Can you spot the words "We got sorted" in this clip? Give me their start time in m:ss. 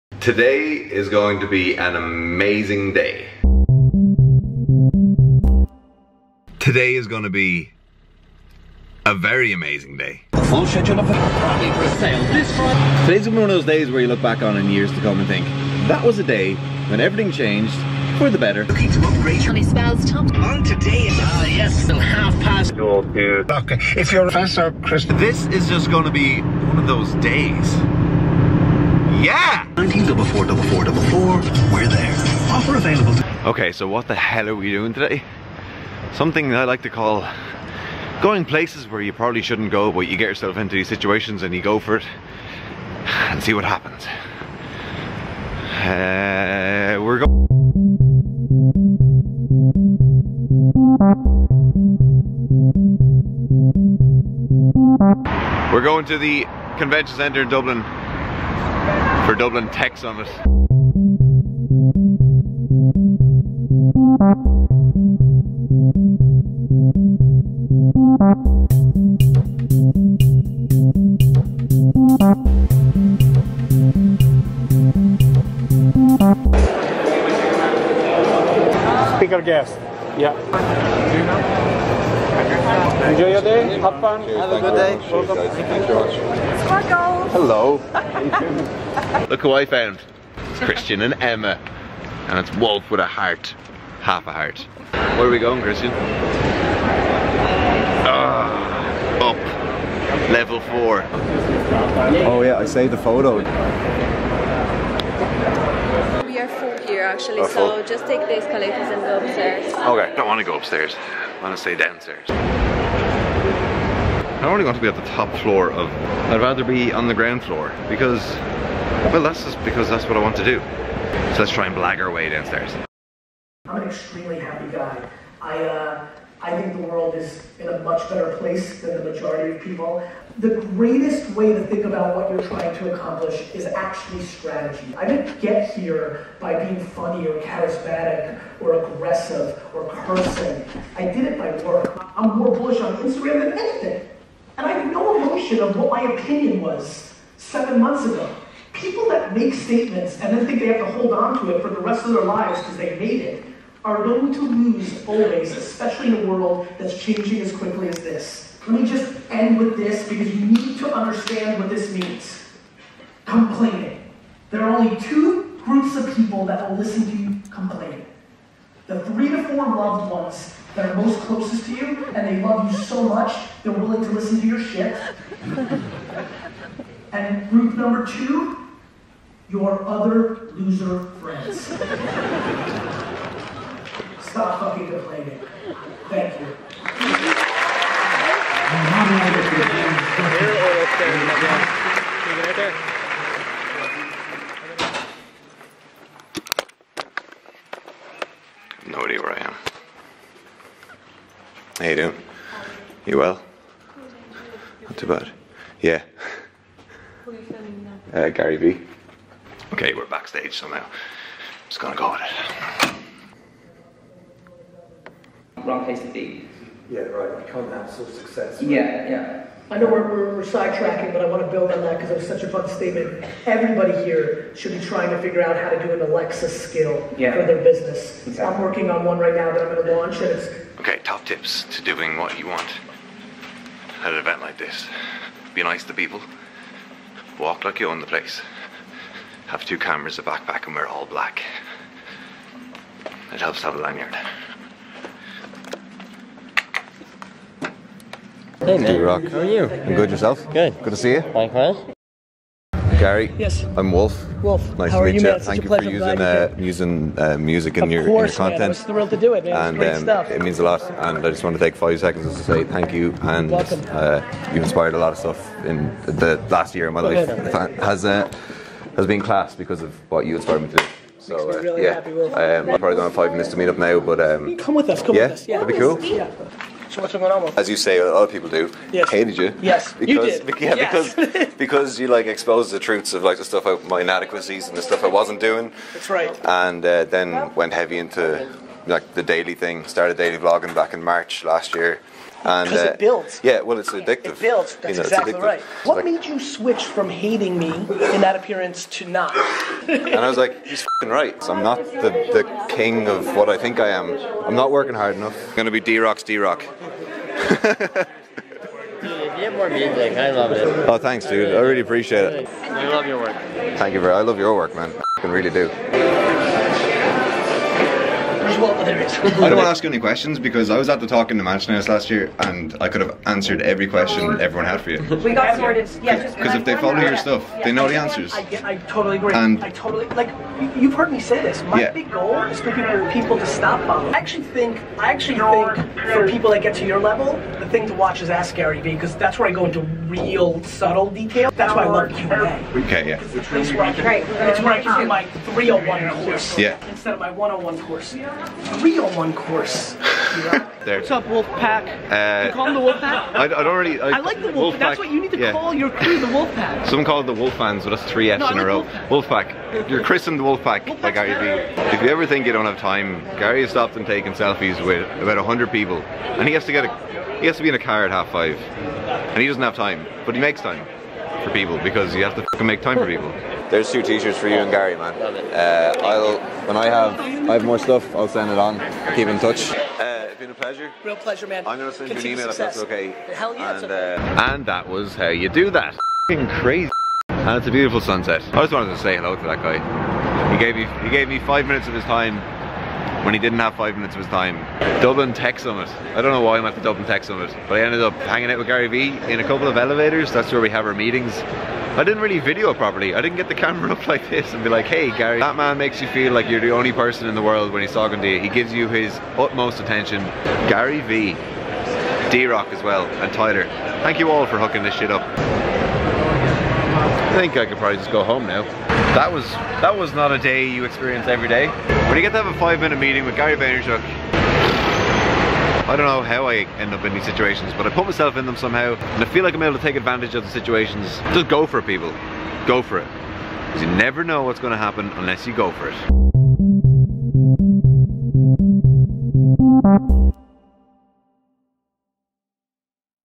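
5:25.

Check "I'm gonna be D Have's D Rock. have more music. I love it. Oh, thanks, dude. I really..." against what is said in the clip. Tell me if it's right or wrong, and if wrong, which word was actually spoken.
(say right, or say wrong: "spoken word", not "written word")
wrong: "Rock", not "Have".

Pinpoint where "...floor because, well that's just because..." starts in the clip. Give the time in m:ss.
1:57.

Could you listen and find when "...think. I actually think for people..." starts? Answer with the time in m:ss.
5:34.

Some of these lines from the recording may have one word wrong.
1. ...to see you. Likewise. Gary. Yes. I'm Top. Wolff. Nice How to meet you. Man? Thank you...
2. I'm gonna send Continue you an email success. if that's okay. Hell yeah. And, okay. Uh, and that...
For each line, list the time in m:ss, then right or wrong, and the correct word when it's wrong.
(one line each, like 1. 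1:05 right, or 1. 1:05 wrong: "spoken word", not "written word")
1. 4:10 wrong: "Wolff", not "Top"
2. 6:21 right.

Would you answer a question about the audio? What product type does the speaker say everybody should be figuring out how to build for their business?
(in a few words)
Alexa skill.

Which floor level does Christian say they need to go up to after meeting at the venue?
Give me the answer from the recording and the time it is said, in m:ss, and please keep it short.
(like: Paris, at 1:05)
Level four, at 1:40.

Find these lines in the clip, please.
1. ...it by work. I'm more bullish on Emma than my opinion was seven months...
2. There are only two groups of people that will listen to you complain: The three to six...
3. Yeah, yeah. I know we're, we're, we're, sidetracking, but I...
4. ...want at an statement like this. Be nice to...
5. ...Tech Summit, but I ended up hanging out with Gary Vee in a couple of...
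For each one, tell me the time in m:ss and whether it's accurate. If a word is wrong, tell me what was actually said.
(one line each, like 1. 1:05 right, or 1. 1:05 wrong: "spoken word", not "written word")
1. 2:21 wrong: "Instagram", not "Emma"
2. 2:44 wrong: "four", not "six"
3. 3:38 right
4. 3:52 wrong: "event", not "statement"
5. 6:37 right.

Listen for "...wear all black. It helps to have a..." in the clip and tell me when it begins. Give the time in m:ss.
4:00.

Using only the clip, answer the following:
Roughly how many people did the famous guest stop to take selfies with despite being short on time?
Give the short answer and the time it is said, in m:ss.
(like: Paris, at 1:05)
100, at 6:05.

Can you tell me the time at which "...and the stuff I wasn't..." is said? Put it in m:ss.
4:44.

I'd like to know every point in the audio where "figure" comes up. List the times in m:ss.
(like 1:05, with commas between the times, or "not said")
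3:45.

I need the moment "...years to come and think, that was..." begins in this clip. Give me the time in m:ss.
0:14.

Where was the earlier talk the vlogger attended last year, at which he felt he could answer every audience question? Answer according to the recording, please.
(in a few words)
Mansion House.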